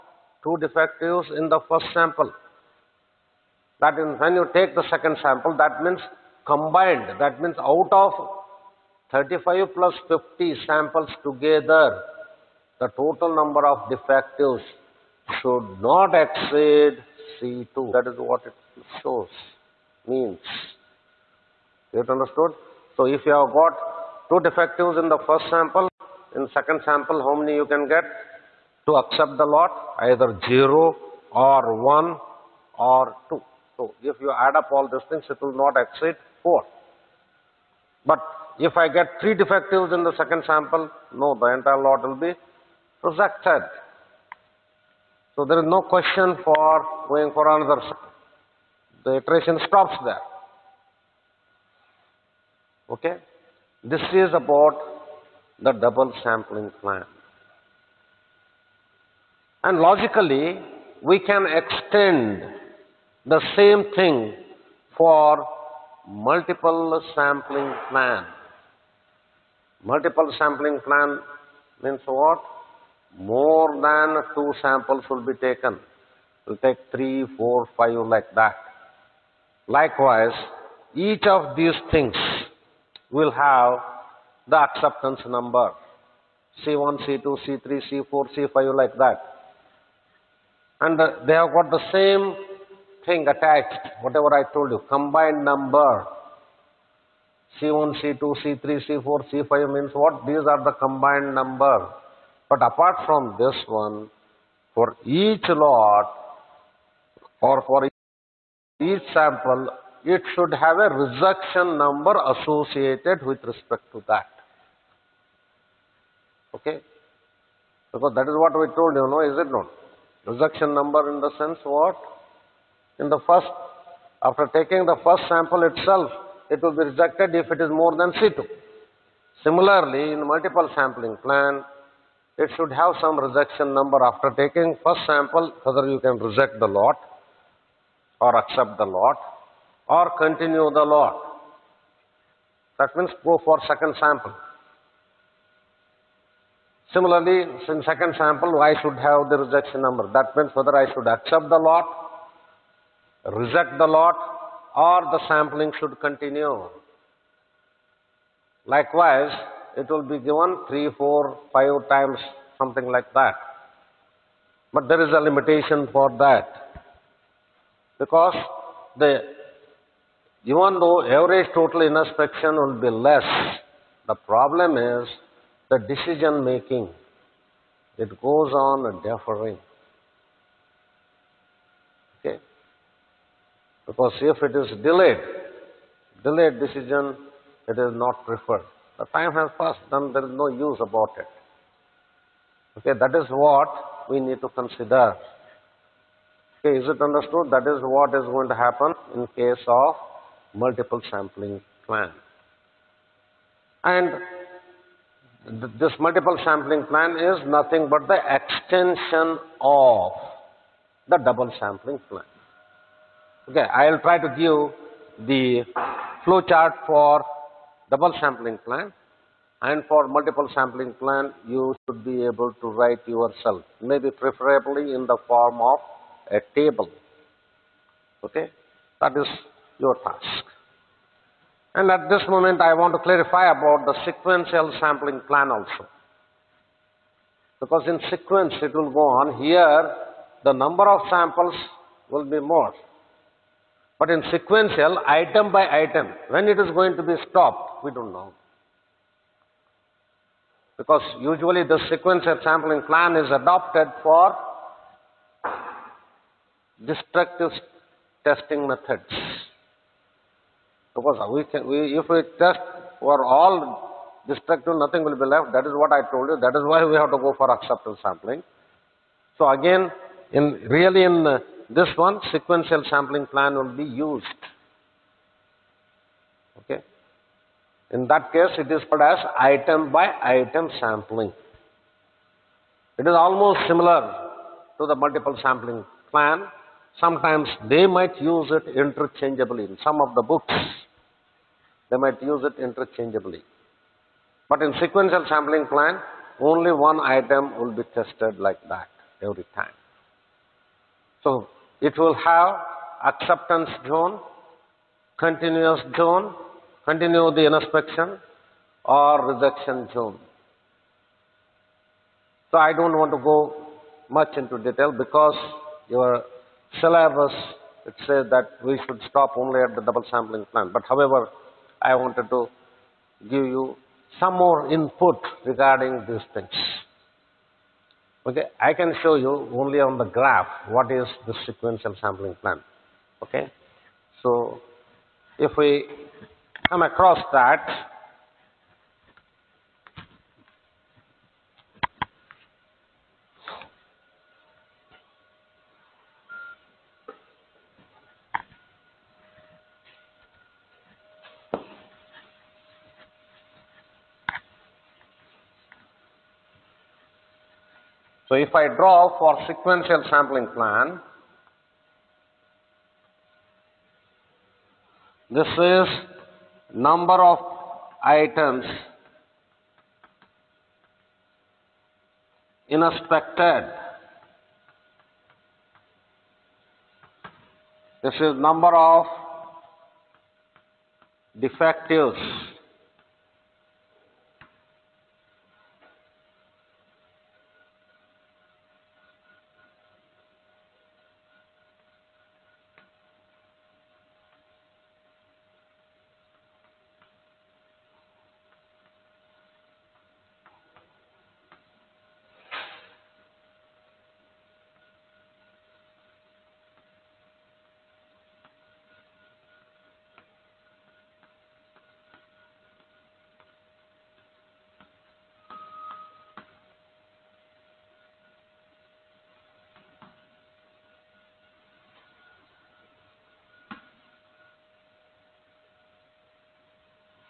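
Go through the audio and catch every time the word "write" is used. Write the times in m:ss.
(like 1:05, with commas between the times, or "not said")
3:42.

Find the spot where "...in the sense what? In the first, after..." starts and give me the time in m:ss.
2:01.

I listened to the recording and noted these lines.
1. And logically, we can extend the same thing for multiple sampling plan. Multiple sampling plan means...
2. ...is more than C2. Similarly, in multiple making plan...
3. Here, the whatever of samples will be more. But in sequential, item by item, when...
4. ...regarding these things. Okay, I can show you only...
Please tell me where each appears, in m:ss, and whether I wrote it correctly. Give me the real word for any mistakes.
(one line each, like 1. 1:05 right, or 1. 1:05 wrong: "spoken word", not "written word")
1. 0:59 right
2. 2:07 wrong: "sampling", not "making"
3. 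3:59 wrong: "number", not "whatever"
4. 5:25 right.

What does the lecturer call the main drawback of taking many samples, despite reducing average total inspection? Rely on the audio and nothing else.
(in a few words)
decision making.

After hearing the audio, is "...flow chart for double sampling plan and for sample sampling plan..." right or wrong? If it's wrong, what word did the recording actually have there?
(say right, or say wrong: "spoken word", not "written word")
wrong: "multiple", not "sample".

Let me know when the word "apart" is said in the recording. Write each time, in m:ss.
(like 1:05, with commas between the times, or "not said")
1:42.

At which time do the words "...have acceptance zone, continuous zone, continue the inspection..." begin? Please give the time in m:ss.
5:02.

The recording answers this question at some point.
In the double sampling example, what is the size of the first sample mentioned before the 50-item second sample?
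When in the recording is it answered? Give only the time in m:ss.
0:09.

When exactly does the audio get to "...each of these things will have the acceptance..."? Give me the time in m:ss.
1:20.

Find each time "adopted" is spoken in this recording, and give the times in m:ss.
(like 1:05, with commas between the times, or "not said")
4:13.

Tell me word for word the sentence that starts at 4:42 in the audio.
It is almost similar to the multiple sampling plan, Sometimes they might use it interchangeably.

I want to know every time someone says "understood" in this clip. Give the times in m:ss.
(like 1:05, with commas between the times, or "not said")
0:21, 3:16.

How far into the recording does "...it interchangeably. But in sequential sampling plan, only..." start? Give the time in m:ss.
4:52.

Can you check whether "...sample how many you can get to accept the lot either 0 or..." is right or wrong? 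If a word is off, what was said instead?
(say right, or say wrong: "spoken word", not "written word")
right.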